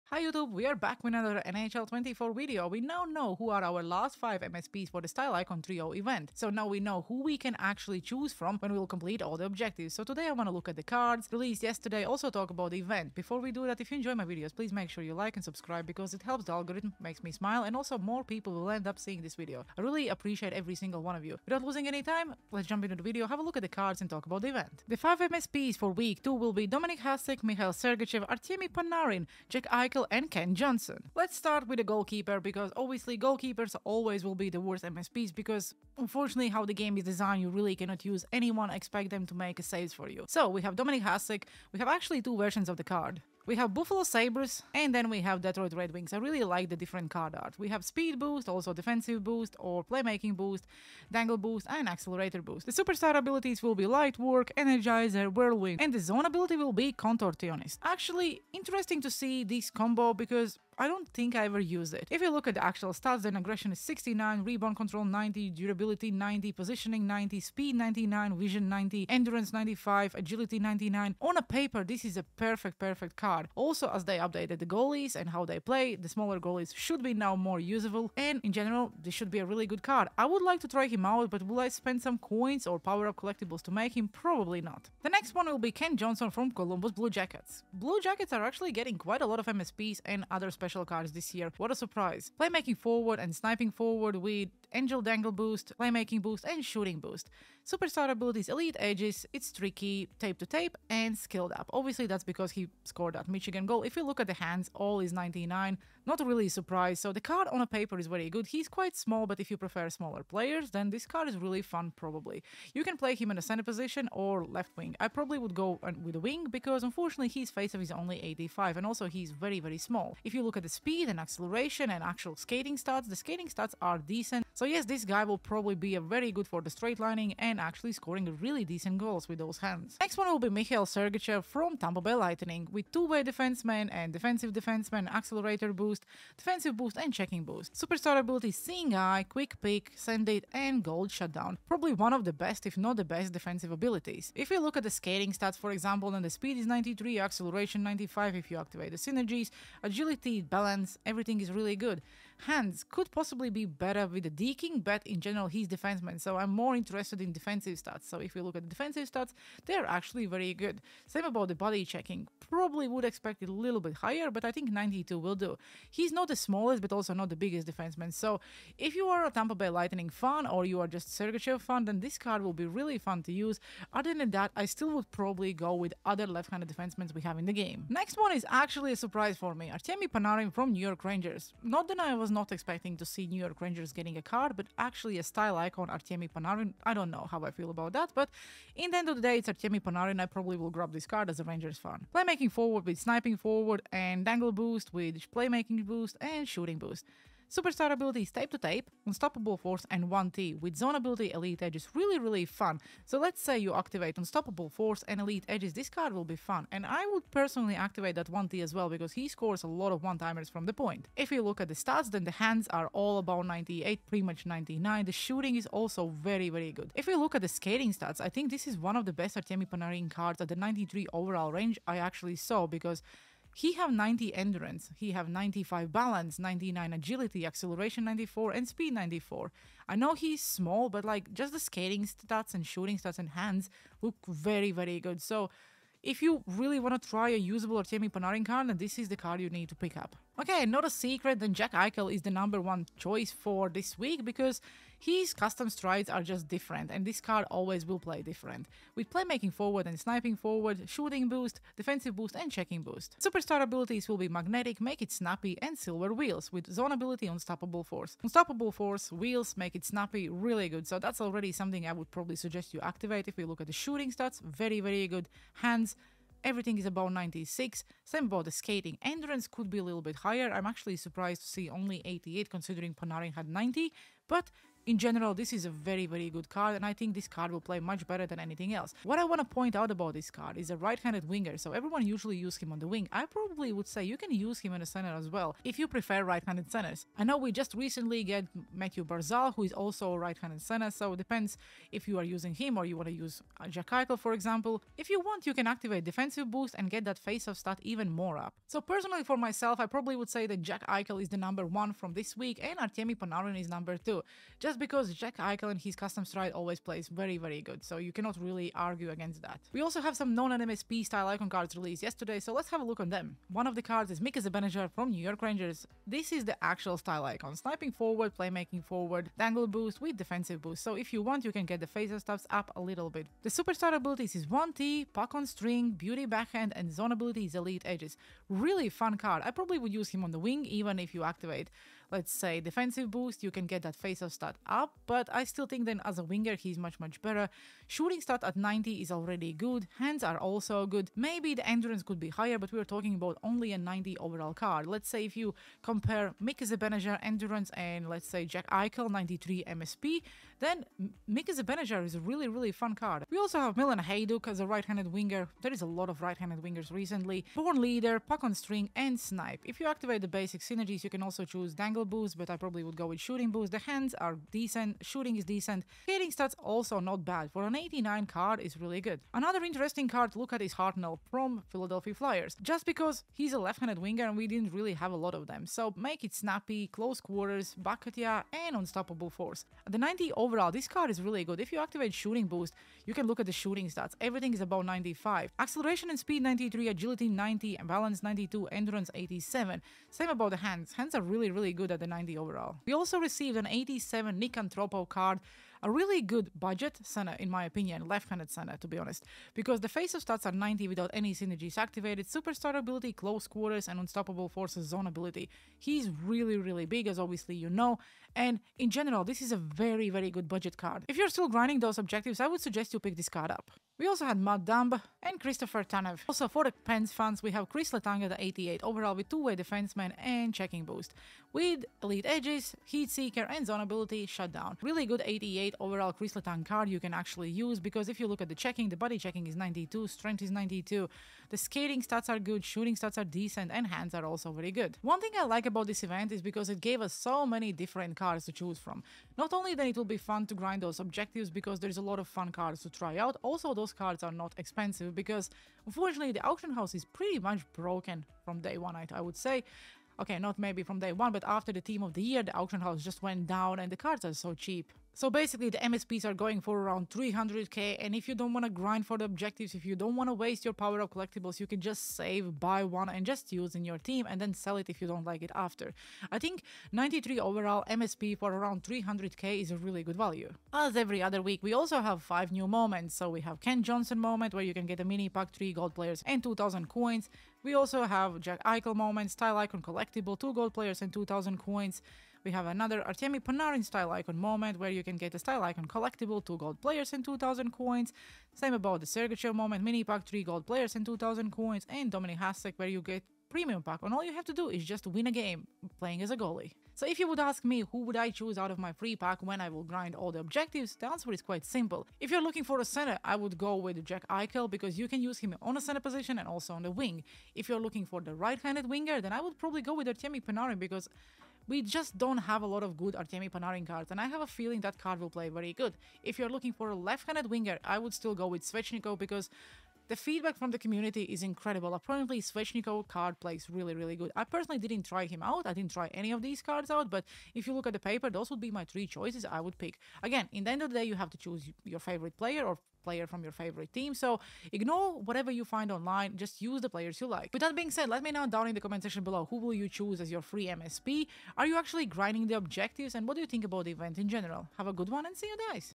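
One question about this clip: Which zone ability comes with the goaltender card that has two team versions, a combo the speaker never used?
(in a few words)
Contortionist.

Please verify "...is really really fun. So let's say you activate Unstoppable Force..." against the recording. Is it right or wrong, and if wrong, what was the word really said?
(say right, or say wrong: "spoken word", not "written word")
right.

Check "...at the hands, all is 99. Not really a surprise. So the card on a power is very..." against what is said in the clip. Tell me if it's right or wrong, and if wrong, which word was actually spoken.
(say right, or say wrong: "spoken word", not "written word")
wrong: "paper", not "power".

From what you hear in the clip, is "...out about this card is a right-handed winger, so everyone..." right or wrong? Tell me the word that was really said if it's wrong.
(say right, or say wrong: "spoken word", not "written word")
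right.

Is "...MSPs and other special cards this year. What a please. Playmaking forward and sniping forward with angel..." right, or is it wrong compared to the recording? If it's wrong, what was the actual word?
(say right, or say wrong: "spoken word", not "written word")
wrong: "surprise", not "please".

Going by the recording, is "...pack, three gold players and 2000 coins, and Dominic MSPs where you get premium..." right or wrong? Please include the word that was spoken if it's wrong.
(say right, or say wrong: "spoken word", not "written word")
wrong: "Hasek", not "MSPs".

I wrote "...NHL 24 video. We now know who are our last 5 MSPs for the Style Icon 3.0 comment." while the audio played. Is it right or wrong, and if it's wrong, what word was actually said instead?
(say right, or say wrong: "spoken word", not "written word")
wrong: "event", not "comment".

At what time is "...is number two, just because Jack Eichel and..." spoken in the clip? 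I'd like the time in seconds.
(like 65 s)
303 s.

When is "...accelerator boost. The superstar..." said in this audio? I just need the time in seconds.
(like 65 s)
51 s.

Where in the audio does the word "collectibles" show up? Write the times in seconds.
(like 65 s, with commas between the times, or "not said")
83 s, 461 s, 479 s, 485 s.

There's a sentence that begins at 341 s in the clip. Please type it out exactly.
Maybe the endurance could be higher, but we are talking about only a 90 overall card.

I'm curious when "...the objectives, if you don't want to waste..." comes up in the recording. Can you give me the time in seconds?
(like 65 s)
459 s.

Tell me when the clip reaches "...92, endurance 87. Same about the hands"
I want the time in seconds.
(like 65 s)
388 s.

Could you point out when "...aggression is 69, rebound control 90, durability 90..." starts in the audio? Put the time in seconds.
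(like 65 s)
63 s.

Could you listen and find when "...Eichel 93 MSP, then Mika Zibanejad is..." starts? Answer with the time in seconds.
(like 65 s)
348 s.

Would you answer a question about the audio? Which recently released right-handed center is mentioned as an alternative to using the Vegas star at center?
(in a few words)
Mathew Barzal.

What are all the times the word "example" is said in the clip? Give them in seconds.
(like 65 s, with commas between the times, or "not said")
145 s, 294 s.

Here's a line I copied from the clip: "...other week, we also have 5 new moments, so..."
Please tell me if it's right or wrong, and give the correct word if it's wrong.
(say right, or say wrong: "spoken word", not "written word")
right.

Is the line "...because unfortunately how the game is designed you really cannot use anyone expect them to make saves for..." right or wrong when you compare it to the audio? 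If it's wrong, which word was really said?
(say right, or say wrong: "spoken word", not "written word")
right.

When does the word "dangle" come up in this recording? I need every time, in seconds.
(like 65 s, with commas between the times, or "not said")
51 s, 95 s, 194 s, 319 s, 361 s.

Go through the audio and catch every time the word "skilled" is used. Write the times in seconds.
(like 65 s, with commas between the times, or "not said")
101 s.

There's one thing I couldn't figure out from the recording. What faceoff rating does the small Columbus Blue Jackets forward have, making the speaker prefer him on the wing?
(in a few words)
85.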